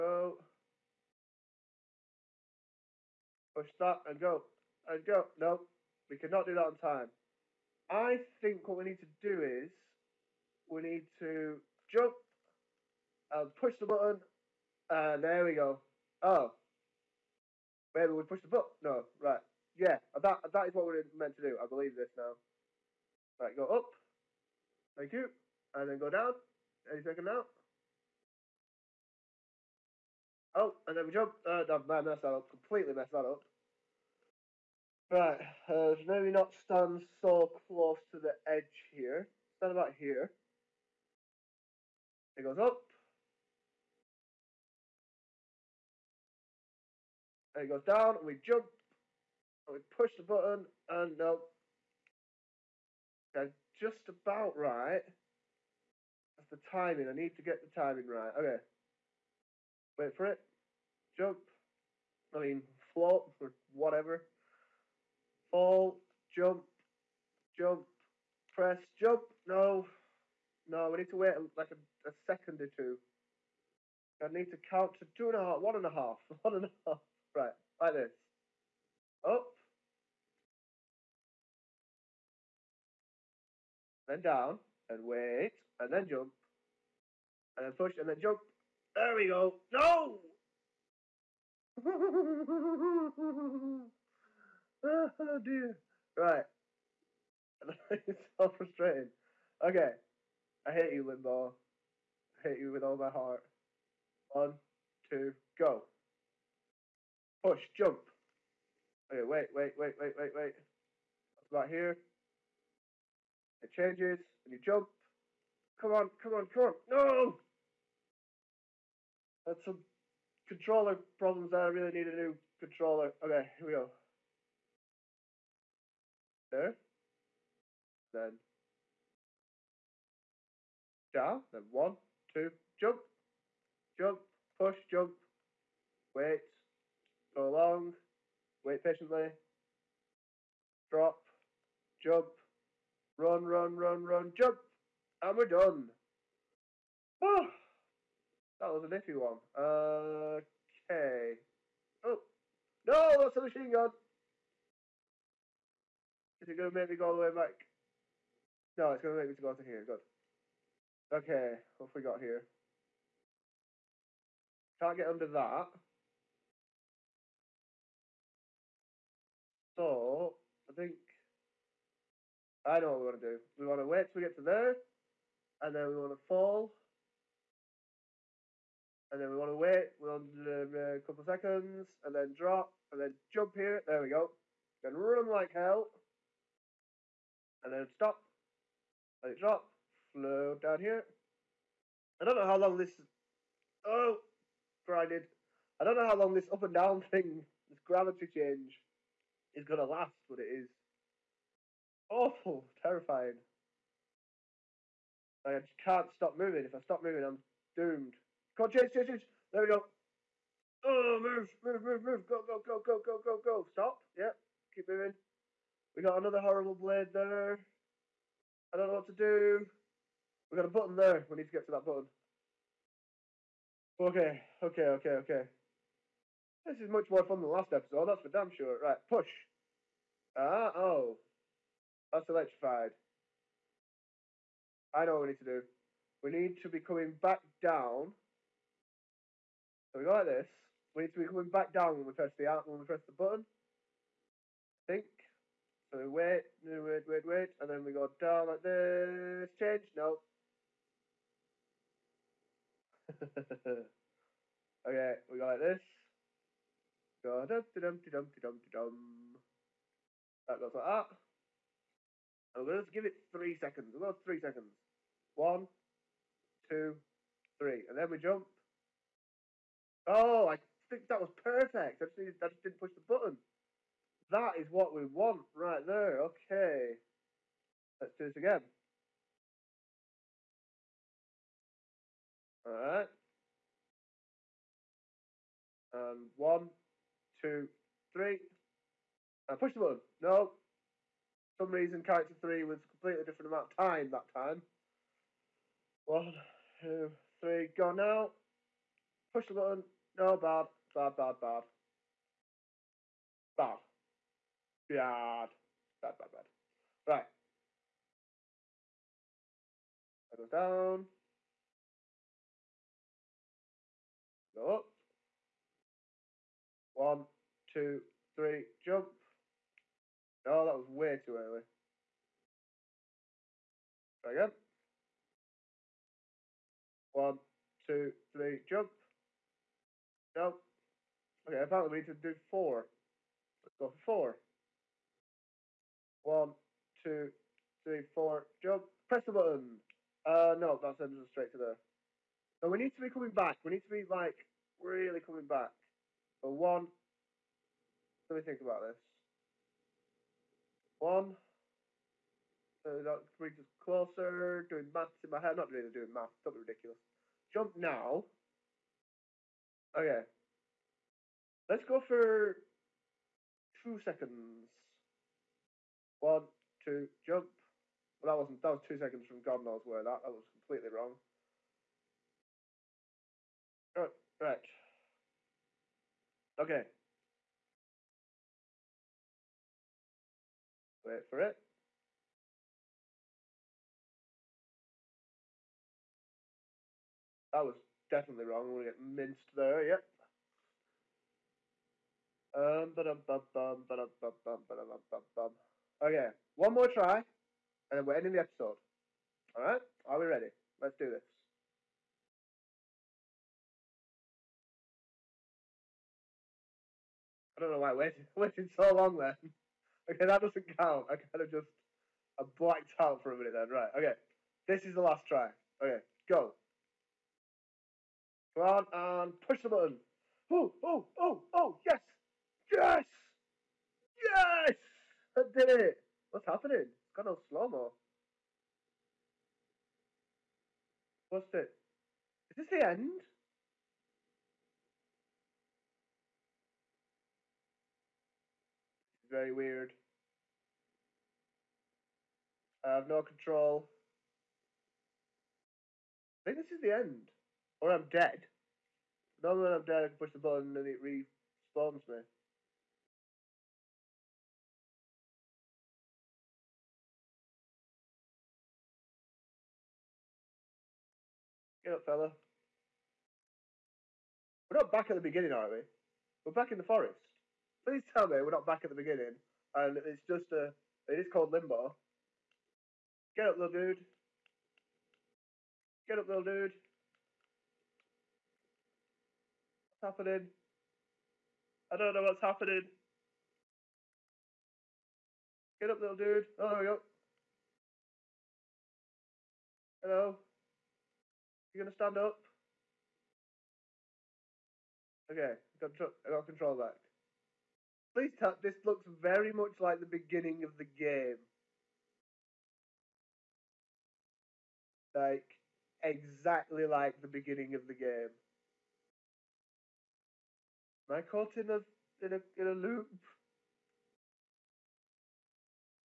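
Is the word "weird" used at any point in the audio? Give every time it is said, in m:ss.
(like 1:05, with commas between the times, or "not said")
7:19.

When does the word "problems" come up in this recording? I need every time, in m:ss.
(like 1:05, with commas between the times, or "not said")
2:00.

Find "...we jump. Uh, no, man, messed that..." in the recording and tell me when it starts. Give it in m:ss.
0:31.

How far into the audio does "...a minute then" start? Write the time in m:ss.
6:53.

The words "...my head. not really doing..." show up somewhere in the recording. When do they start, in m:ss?
5:55.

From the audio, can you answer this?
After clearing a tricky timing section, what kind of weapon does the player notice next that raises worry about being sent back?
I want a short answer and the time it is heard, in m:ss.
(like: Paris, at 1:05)
machine gun, at 2:33.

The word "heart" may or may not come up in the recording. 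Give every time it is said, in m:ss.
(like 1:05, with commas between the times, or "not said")
1:43.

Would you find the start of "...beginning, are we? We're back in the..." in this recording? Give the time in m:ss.
7:45.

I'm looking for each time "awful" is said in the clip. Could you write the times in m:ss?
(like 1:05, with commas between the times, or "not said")
3:22.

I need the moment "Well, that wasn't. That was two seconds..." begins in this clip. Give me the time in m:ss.
6:08.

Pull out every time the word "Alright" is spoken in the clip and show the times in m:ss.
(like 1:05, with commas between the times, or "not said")
4:42, 6:39.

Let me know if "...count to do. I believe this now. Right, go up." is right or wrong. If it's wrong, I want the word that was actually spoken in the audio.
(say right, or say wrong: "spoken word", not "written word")
wrong: "meant", not "count".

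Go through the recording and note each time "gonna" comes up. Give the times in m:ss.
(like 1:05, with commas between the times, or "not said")
3:19, 8:11.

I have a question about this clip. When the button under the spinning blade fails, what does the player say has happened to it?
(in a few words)
electrified.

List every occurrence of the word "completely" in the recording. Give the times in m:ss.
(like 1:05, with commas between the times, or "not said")
0:32, 4:52, 6:10.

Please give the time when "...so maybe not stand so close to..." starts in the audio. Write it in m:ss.
0:35.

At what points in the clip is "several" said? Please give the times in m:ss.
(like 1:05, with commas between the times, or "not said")
not said.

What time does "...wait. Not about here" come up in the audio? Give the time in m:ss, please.
1:50.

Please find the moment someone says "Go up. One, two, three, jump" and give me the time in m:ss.
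5:14.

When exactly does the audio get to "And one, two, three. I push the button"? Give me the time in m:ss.
4:45.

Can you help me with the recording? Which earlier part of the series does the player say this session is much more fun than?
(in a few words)
the last episode.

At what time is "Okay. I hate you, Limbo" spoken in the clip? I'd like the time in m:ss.
1:39.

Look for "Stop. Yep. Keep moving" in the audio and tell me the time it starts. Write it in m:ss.
3:33.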